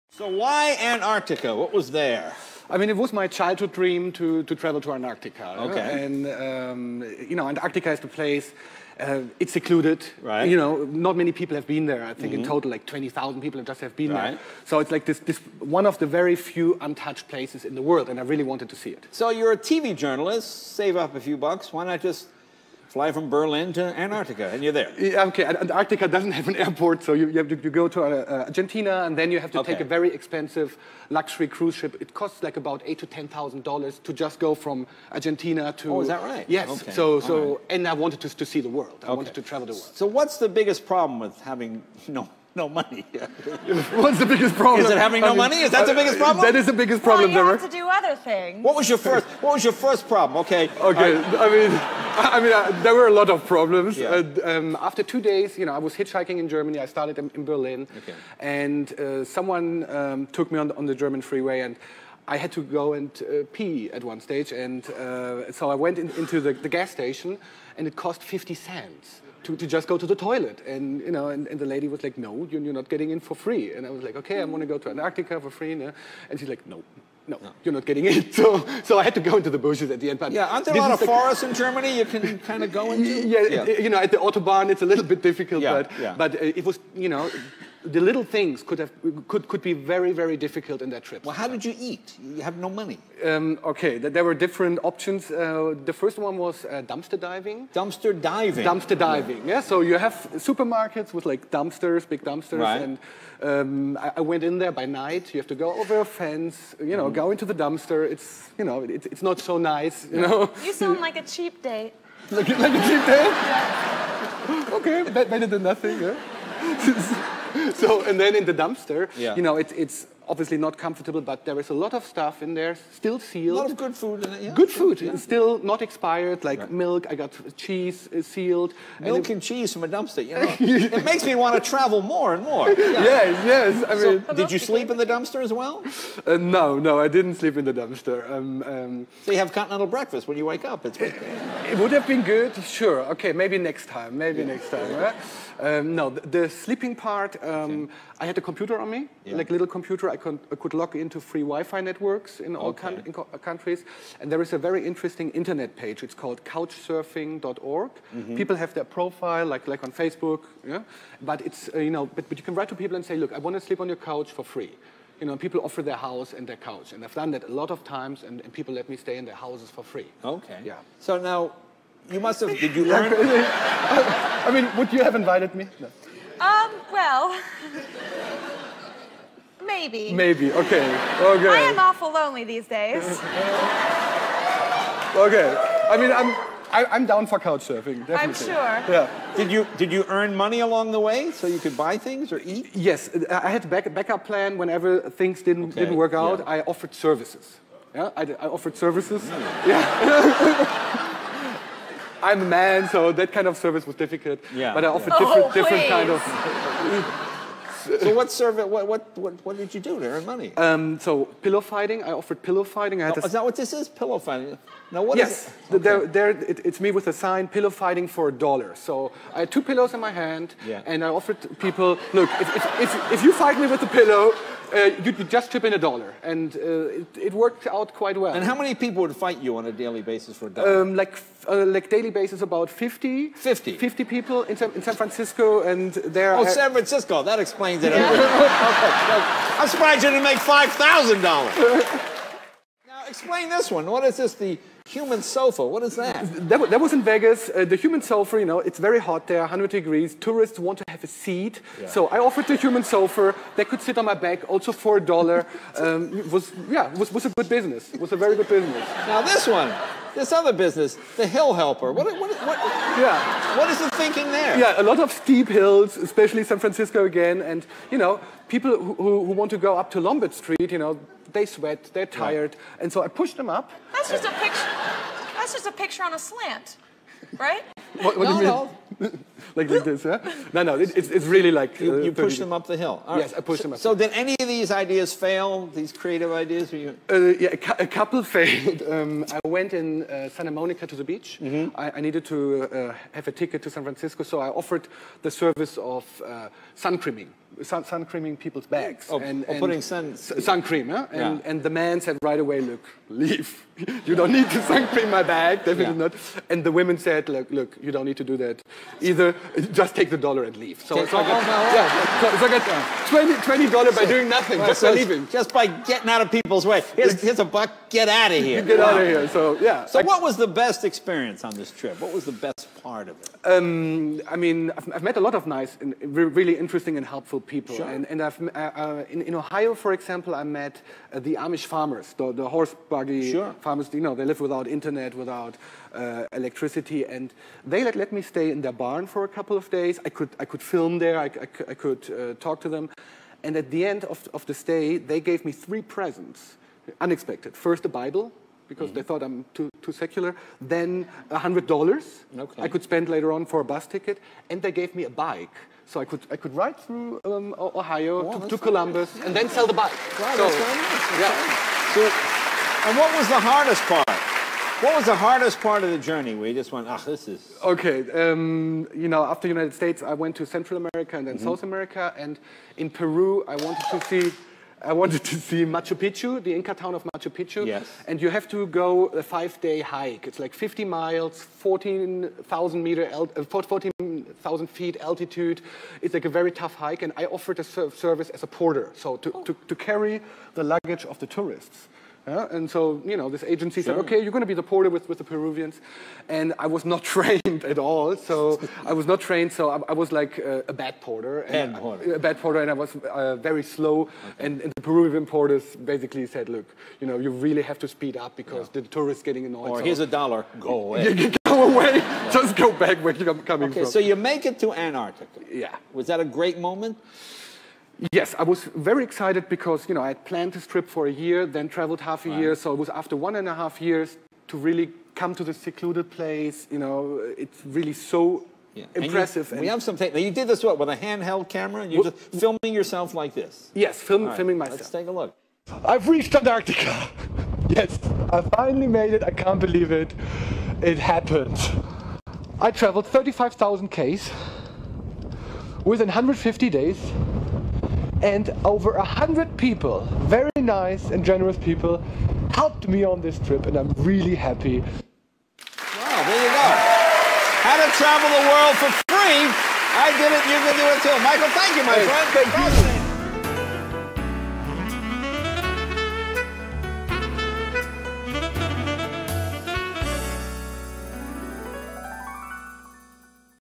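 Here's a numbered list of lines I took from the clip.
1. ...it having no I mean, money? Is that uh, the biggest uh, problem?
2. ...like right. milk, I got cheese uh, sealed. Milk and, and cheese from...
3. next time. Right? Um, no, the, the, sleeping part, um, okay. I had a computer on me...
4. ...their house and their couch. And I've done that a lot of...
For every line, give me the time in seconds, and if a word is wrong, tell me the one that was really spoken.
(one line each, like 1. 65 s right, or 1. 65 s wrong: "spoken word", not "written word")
1. 44 s right
2. 126 s right
3. 144 s right
4. 165 s right.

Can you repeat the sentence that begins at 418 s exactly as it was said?
Yes, I was very excited because, you know, I had planned this trip for a year, then traveled half a right.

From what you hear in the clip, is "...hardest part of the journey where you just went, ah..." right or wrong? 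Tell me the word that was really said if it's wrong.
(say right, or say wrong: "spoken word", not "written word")
right.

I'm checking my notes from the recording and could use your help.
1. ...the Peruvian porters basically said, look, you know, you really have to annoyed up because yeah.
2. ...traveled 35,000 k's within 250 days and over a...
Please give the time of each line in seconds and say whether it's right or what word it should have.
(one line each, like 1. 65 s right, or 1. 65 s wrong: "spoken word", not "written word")
1. 404 s wrong: "speed", not "annoyed"
2. 442 s wrong: "150", not "250".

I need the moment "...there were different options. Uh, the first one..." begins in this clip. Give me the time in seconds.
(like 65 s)
93 s.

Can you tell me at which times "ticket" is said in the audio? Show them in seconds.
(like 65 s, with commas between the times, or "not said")
293 s, 353 s.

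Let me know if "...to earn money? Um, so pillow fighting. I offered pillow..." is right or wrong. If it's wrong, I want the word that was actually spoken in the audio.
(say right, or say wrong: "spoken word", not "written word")
right.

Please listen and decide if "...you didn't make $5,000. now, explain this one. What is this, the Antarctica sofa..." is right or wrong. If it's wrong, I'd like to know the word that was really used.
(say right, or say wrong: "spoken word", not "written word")
wrong: "Human", not "Antarctica".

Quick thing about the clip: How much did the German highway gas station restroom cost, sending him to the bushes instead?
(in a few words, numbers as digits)
50 cents.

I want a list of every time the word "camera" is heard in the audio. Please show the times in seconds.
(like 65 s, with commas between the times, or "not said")
431 s.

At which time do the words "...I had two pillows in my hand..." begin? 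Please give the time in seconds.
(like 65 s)
219 s.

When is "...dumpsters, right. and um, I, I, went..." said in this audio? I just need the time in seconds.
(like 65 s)
102 s.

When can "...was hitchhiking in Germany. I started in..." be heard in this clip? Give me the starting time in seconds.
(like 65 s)
55 s.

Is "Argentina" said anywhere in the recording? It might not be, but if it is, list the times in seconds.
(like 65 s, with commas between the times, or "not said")
28 s, 35 s.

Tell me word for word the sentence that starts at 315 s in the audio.
Just by getting out of people's way.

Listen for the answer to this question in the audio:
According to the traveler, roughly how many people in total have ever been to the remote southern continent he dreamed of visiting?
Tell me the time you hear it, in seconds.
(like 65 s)
12 s.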